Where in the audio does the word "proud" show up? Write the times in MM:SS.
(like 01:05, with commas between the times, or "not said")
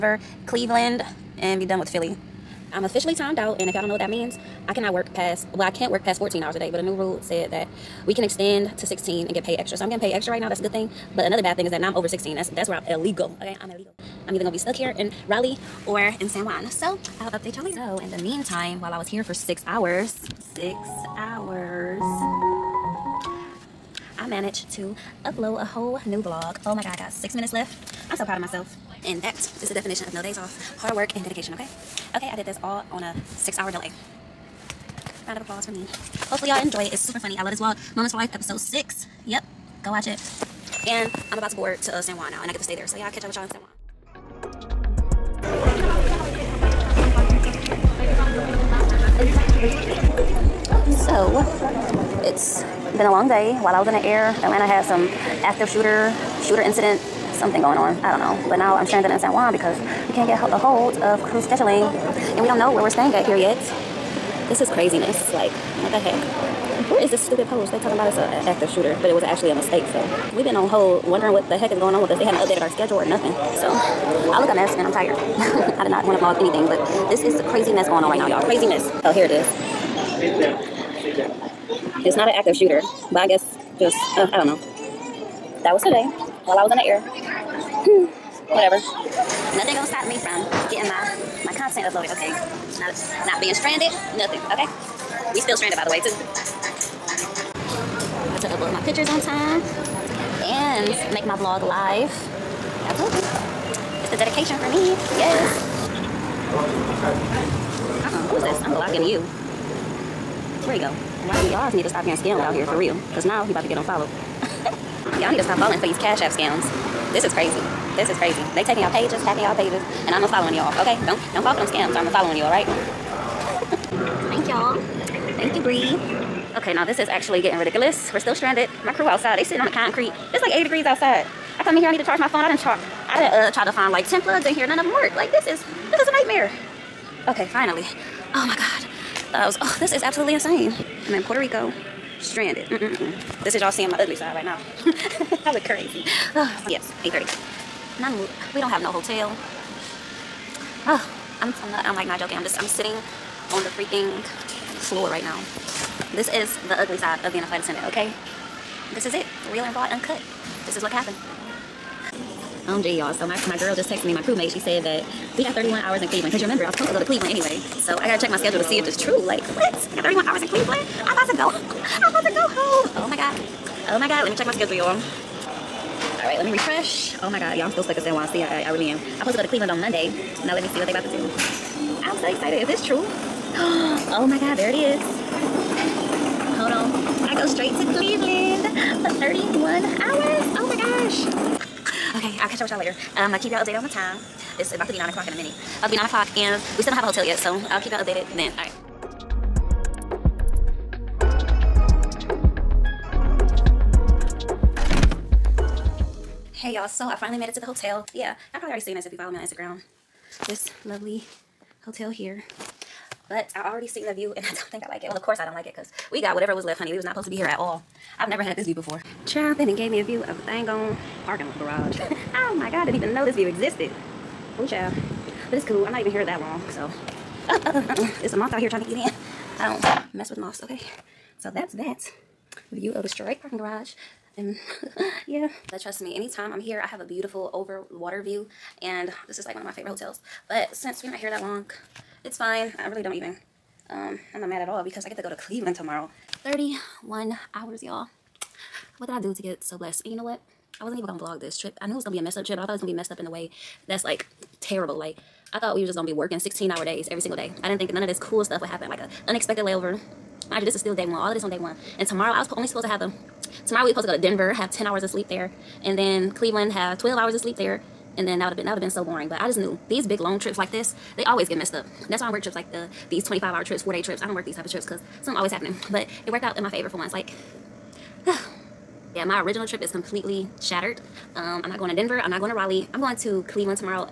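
00:28.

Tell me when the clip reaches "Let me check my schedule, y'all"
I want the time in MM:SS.
02:54.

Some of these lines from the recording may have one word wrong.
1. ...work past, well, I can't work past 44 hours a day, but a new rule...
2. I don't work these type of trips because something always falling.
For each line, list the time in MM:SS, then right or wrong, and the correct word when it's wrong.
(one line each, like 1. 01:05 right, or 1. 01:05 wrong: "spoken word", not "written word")
1. 00:04 wrong: "14", not "44"
2. 04:34 wrong: "happening", not "falling".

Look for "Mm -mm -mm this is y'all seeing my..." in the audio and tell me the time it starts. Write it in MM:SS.
02:22.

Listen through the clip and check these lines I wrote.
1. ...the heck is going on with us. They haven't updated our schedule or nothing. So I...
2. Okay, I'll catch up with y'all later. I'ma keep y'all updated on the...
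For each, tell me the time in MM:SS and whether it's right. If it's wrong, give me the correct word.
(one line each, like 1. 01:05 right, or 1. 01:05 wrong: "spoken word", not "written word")
1. 01:11 right
2. 03:12 right.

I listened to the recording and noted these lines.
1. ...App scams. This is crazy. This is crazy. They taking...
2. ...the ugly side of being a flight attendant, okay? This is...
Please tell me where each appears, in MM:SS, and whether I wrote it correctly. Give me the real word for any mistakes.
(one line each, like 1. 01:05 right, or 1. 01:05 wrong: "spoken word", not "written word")
1. 01:56 right
2. 02:36 right.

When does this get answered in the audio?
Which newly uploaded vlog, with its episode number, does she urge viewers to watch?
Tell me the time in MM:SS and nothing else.
00:37.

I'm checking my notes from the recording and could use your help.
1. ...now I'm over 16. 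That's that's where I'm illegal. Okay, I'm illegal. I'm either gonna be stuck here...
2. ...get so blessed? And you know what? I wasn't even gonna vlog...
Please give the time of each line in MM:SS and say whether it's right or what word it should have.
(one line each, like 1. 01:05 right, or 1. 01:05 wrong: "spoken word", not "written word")
1. 00:11 right
2. 04:09 right.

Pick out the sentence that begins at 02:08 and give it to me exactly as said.
My crew outside, they sitting on the concrete it's like 80 degrees outside.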